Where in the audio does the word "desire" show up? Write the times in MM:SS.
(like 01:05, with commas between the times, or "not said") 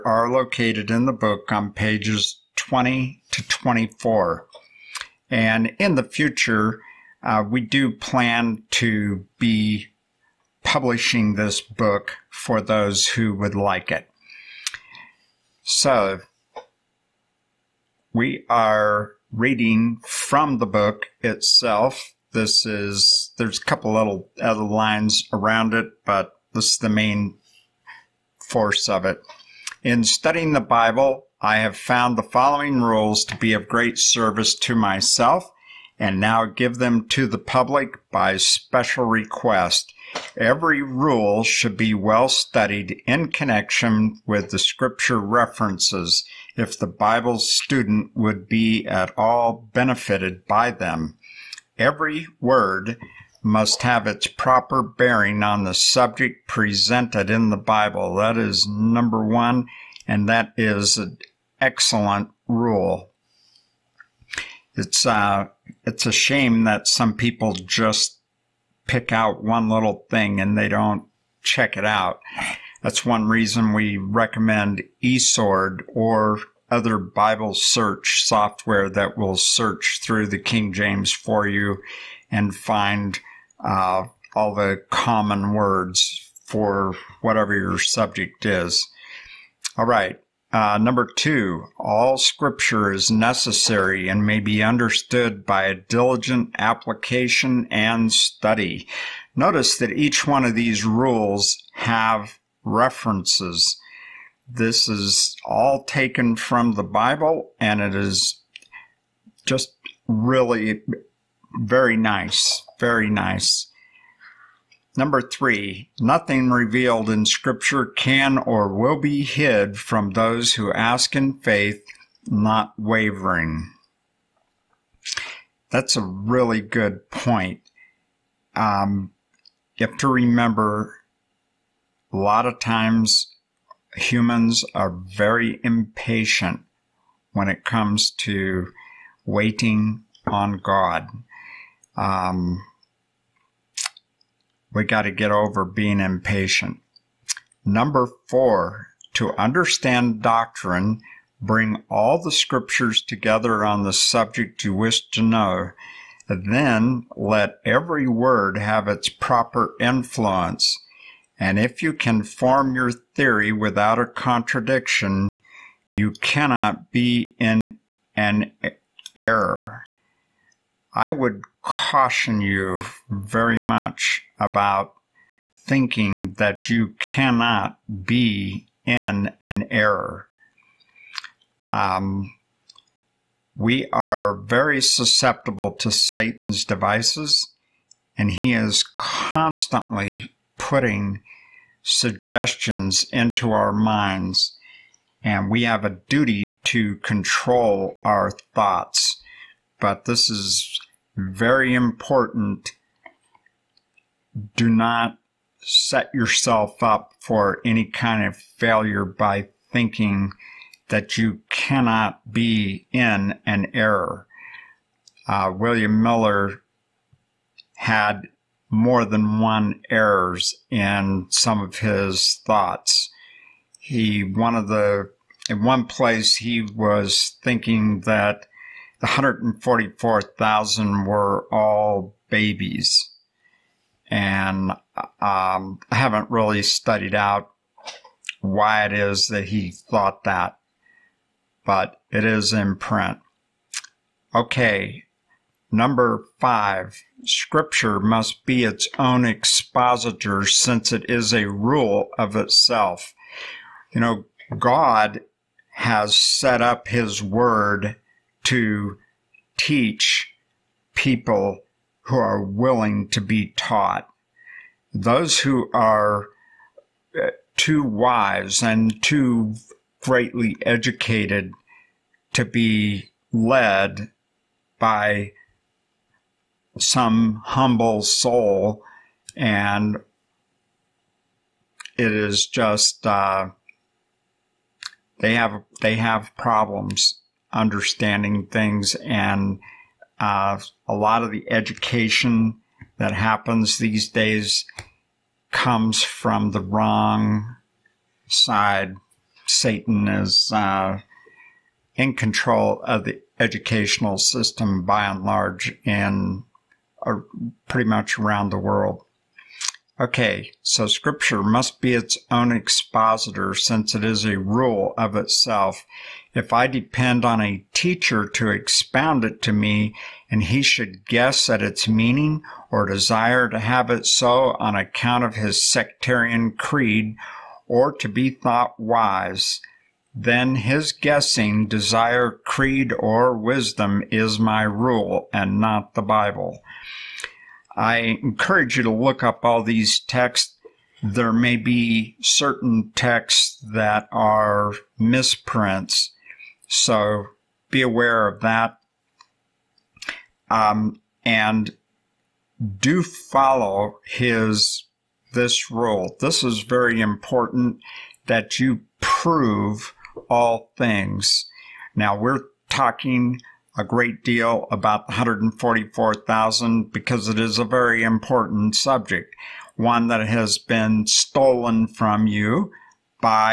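05:22, 05:31.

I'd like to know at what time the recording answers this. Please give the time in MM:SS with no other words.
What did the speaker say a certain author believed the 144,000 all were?
03:52.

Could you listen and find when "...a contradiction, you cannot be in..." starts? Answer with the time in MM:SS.
02:43.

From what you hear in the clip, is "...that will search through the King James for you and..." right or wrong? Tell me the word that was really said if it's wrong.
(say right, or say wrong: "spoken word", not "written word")
right.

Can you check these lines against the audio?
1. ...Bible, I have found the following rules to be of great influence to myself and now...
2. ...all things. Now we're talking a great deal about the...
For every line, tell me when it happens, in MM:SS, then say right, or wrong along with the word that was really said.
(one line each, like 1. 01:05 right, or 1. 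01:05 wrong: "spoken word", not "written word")
1. 00:30 wrong: "service", not "influence"
2. 06:00 right.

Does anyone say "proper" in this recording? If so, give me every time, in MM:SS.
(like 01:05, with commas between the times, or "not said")
00:54, 02:39.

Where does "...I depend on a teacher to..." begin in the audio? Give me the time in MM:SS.
05:16.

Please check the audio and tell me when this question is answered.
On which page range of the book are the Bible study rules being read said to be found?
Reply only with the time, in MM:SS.
00:01.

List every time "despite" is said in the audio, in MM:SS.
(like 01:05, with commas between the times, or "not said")
not said.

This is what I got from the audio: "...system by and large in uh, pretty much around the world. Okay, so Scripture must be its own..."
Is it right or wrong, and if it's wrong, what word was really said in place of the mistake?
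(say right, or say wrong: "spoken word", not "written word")
right.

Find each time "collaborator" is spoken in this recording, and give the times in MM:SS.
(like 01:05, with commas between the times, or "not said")
not said.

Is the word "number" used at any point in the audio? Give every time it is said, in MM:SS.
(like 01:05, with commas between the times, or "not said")
00:58, 01:30, 01:54, 02:27, 04:05.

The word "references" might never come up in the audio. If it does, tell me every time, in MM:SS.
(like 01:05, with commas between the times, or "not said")
00:45, 01:42.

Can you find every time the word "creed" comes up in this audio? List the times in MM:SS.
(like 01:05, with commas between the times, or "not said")
05:26, 05:32.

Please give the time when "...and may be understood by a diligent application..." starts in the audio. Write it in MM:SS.
01:34.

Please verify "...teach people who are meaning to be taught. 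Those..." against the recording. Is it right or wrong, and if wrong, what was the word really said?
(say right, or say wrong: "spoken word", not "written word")
wrong: "willing", not "meaning".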